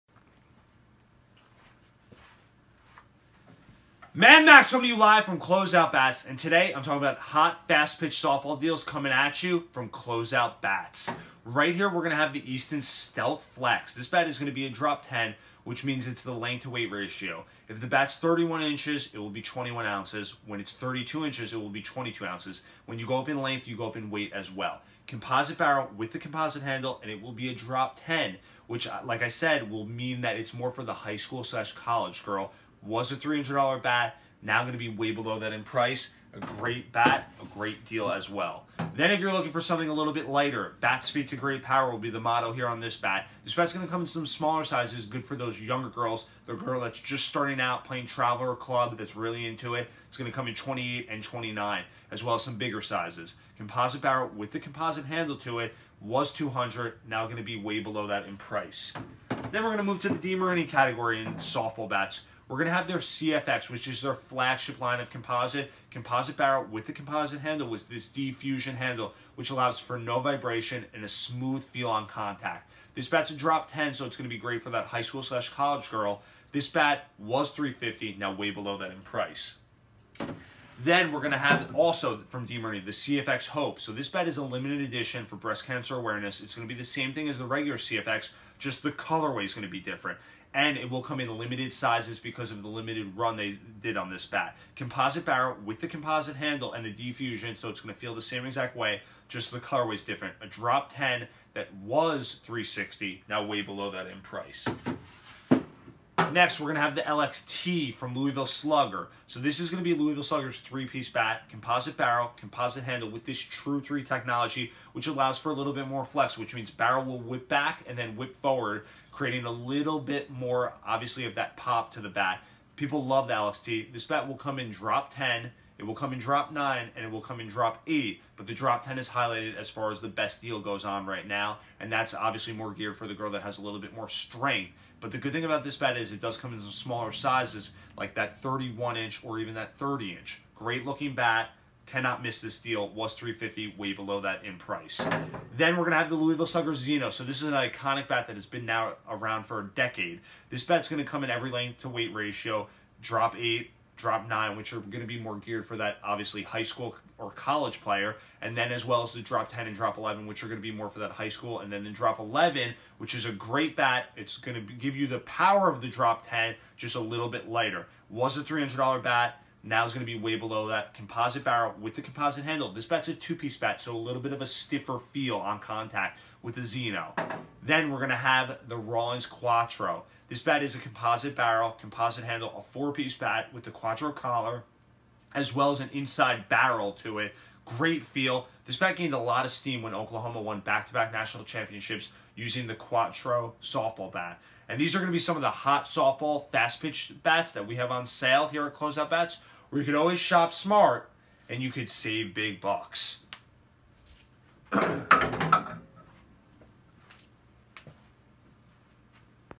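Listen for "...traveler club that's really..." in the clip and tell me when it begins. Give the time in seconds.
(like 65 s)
48 s.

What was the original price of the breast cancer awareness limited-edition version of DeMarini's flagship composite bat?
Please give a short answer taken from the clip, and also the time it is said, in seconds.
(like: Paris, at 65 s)
$360, at 102 s.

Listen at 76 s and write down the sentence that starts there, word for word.
This bat was 350, now way below that in price.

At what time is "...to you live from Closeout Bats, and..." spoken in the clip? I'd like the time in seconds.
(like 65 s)
4 s.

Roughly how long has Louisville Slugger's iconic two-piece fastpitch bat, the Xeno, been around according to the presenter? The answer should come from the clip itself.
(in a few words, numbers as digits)
A decade.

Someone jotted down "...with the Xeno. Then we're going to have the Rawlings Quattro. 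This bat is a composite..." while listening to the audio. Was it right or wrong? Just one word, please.
right.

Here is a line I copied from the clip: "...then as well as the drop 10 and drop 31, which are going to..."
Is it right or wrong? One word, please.
wrong.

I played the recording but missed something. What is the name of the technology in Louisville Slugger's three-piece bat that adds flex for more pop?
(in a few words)
True 3.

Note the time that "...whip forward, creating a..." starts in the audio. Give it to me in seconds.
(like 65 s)
118 s.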